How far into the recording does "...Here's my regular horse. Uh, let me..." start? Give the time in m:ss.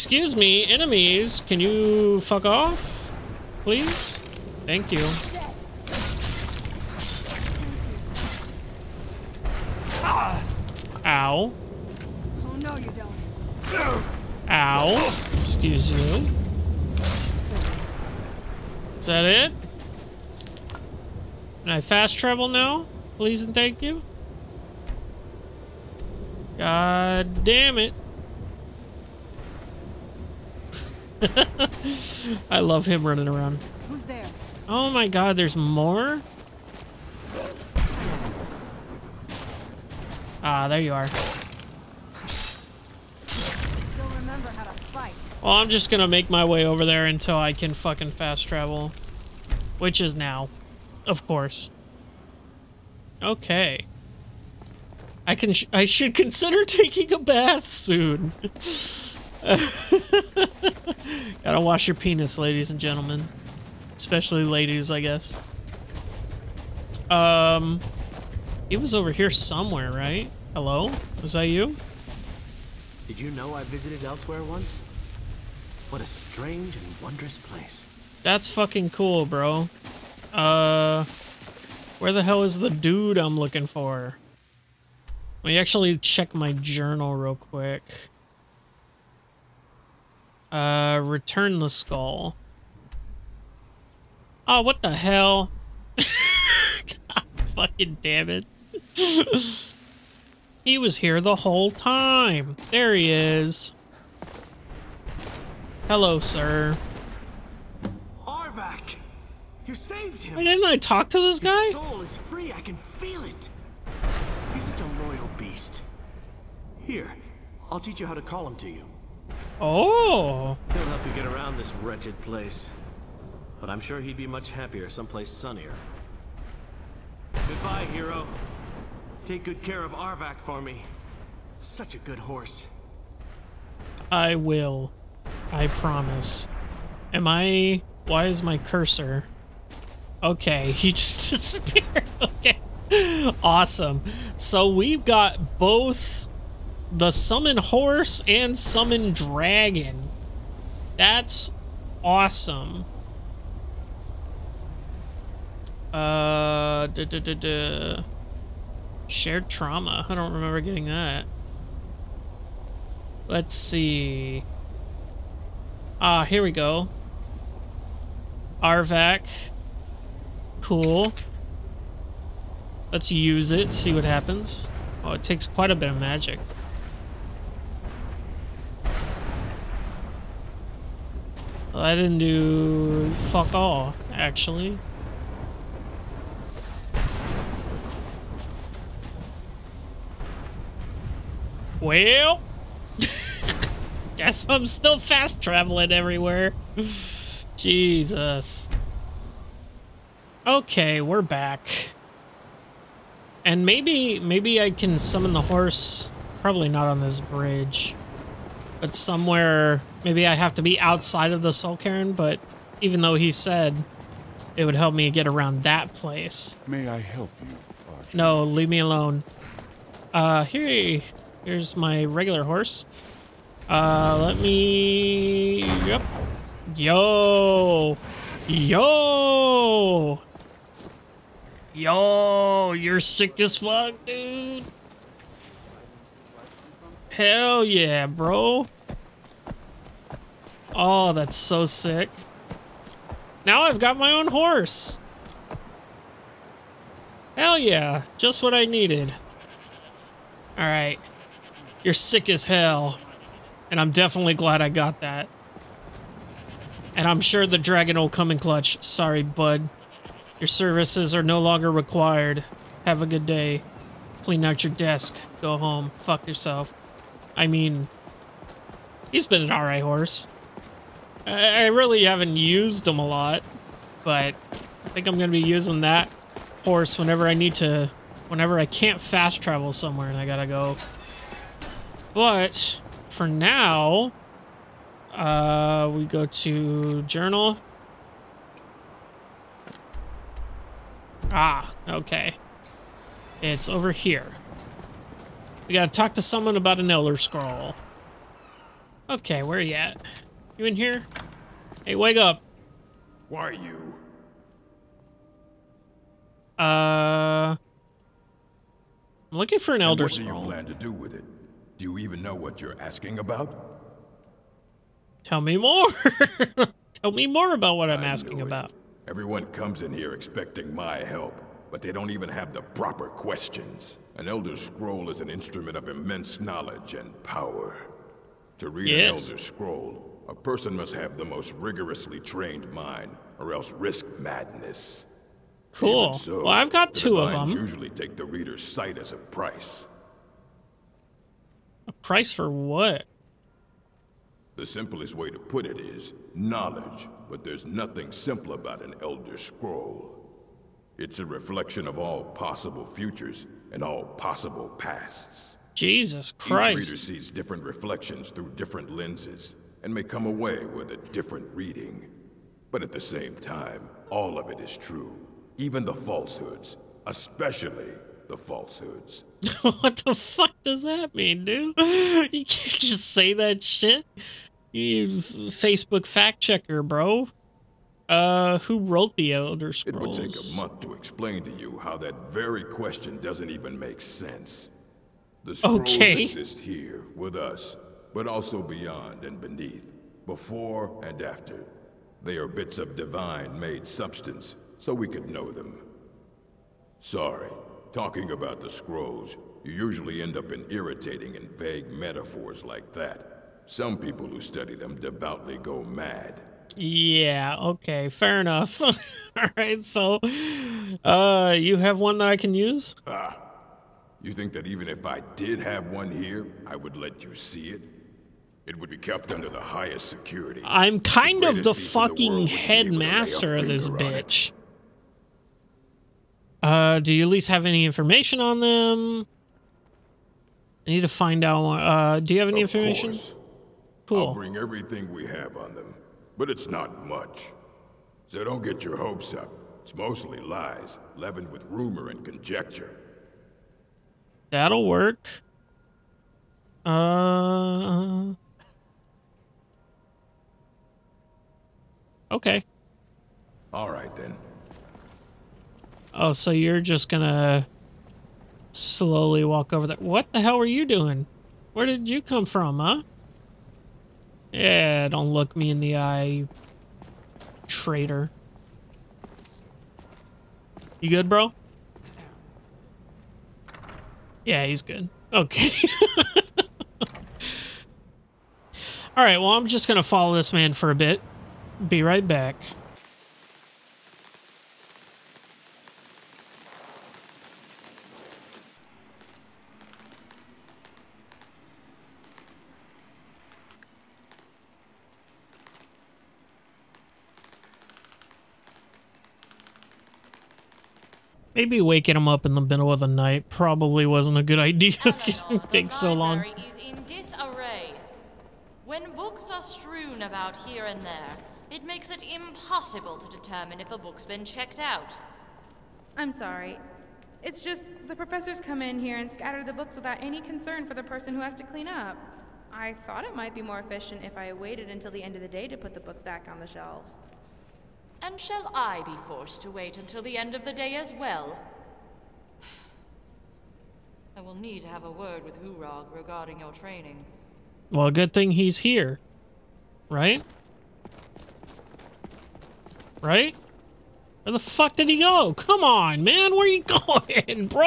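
3:41.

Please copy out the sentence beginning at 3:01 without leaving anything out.
Well, I didn't do fuck all, actually.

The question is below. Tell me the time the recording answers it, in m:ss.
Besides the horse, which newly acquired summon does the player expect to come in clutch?
4:17.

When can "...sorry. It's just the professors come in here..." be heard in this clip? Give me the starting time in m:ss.
8:36.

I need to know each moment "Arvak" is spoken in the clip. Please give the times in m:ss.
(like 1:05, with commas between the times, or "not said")
1:48, 2:09, 2:48.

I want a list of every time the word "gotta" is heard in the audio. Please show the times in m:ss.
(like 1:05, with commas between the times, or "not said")
1:01, 4:40, 4:55.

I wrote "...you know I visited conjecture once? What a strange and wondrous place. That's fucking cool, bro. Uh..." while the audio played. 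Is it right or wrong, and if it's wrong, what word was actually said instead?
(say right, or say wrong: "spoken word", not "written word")
wrong: "elsewhere", not "conjecture".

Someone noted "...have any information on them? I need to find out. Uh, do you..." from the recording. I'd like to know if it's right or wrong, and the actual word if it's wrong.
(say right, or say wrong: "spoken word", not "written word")
right.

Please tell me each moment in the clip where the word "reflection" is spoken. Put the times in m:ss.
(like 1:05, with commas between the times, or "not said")
5:51, 5:57.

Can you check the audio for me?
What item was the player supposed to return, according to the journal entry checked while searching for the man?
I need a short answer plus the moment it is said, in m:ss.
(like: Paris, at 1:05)
the skull, at 1:31.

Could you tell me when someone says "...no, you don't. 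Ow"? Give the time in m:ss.
0:12.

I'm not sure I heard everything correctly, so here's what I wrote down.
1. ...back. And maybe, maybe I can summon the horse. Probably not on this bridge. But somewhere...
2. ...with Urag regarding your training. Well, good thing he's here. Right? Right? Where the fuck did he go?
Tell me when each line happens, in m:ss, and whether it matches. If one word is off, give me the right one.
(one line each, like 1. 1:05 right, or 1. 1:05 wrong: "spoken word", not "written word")
1. 3:21 right
2. 8:55 right.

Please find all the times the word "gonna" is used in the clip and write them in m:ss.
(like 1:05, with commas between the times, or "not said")
0:45, 7:37.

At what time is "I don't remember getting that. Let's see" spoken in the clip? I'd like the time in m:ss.
2:40.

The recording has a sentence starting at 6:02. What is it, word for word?
But at the same time, all of it is true, even the falsehoods, especially the falsehoods.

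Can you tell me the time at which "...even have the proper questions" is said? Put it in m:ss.
5:22.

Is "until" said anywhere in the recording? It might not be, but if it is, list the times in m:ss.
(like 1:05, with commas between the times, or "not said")
0:47, 8:44, 8:49.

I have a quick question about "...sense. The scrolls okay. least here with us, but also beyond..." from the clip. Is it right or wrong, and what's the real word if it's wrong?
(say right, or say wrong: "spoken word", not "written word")
wrong: "exist", not "least".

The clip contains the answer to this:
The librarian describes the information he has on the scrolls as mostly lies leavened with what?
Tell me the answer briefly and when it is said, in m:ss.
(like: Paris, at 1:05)
rumor and conjecture, at 7:21.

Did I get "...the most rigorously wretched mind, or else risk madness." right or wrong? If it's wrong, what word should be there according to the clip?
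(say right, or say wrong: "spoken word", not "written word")
wrong: "trained", not "wretched".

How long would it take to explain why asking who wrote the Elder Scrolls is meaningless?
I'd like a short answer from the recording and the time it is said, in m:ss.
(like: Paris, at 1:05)
a month, at 6:20.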